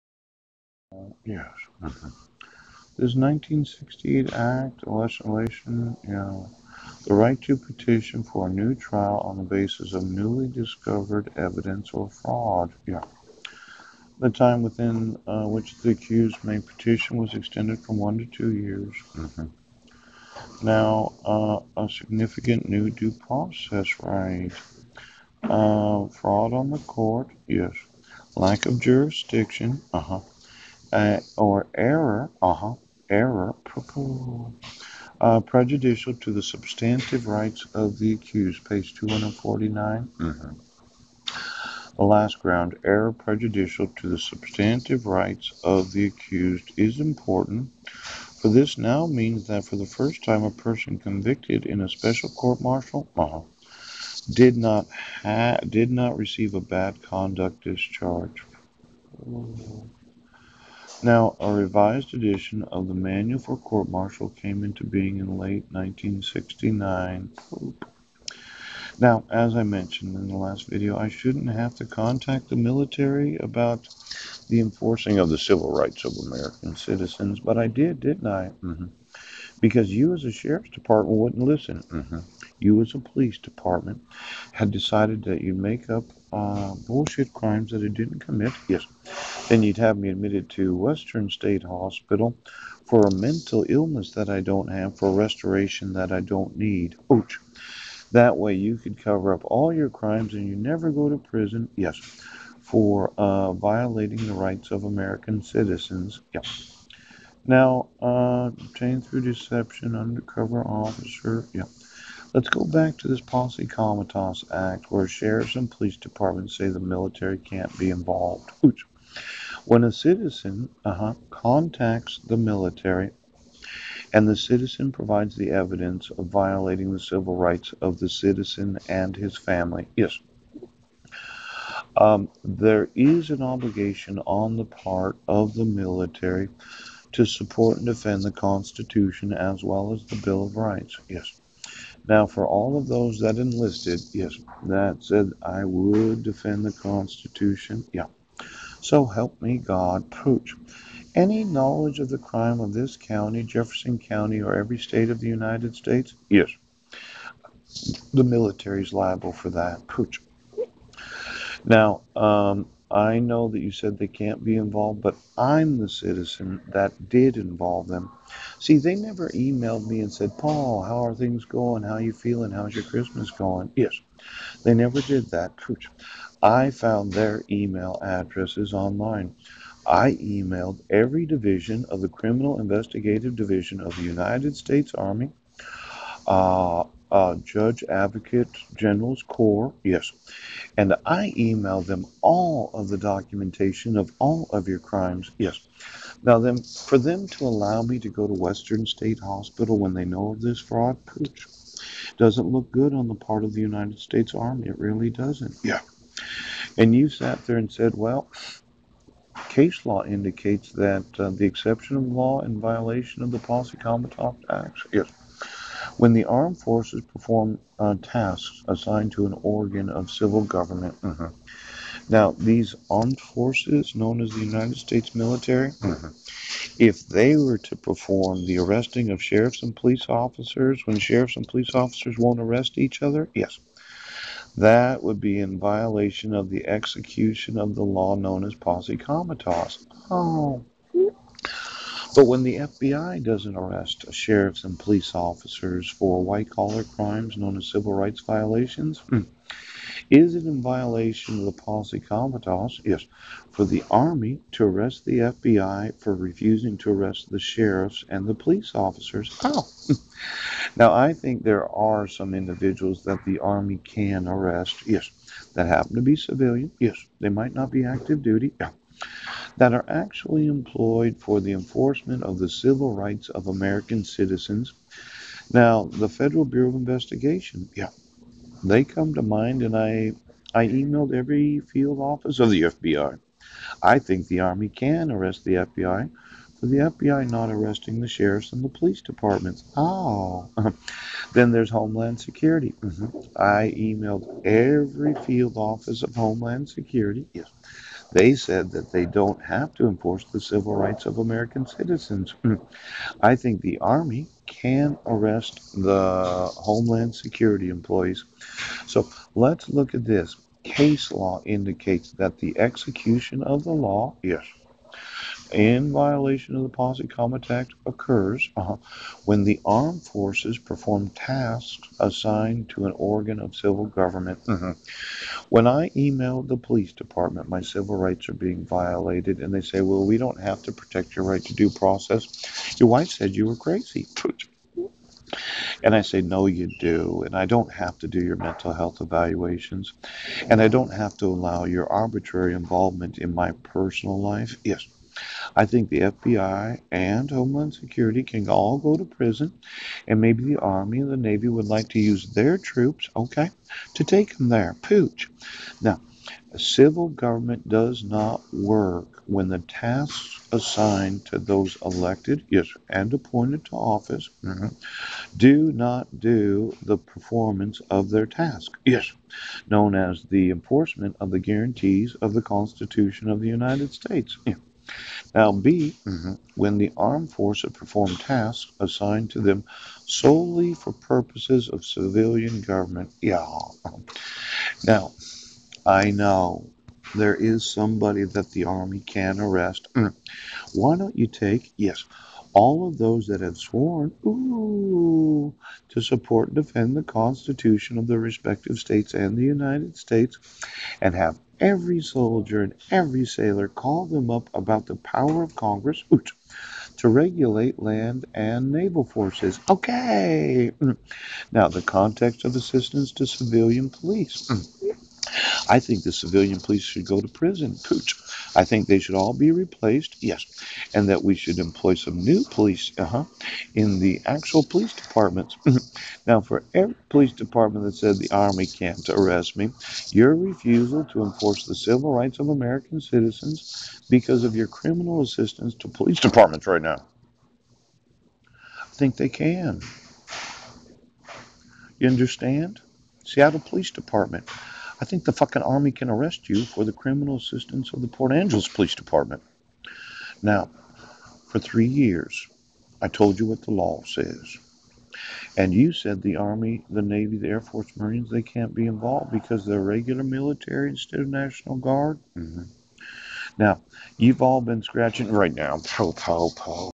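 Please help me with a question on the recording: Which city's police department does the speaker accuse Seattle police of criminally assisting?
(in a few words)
Port Angeles.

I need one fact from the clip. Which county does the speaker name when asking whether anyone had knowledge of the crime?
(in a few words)
Jefferson County.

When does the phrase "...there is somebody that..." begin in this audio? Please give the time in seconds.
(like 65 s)
387 s.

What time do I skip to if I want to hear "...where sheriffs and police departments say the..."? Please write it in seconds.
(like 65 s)
114 s.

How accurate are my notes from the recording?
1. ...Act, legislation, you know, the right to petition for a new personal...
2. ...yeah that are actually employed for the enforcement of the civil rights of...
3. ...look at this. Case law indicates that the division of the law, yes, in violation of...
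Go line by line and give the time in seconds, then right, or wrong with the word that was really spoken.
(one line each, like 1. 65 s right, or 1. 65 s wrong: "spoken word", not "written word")
1. 4 s wrong: "trial", not "personal"
2. 268 s right
3. 309 s wrong: "execution", not "division".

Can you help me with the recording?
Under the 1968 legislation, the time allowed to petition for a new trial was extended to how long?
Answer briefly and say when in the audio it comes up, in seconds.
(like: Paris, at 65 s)
2 years, at 18 s.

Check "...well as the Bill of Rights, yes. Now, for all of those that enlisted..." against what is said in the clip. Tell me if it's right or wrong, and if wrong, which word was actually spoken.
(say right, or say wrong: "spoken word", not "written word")
right.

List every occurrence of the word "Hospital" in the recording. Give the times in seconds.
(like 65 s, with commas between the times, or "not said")
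91 s, 199 s.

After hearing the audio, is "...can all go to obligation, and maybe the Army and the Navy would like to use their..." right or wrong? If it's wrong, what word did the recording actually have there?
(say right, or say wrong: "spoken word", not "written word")
wrong: "prison", not "obligation".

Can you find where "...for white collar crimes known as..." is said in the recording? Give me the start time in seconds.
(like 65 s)
245 s.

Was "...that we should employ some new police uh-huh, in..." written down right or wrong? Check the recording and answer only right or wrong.
right.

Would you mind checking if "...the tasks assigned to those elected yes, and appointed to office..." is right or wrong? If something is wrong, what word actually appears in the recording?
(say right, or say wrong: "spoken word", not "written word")
right.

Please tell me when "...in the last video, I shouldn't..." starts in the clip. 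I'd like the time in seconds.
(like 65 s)
70 s.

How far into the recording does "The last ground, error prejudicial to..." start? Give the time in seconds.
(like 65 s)
41 s.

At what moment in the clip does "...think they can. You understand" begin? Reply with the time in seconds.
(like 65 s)
438 s.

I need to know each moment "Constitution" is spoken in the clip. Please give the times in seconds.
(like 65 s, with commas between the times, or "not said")
138 s, 146 s, 372 s, 397 s.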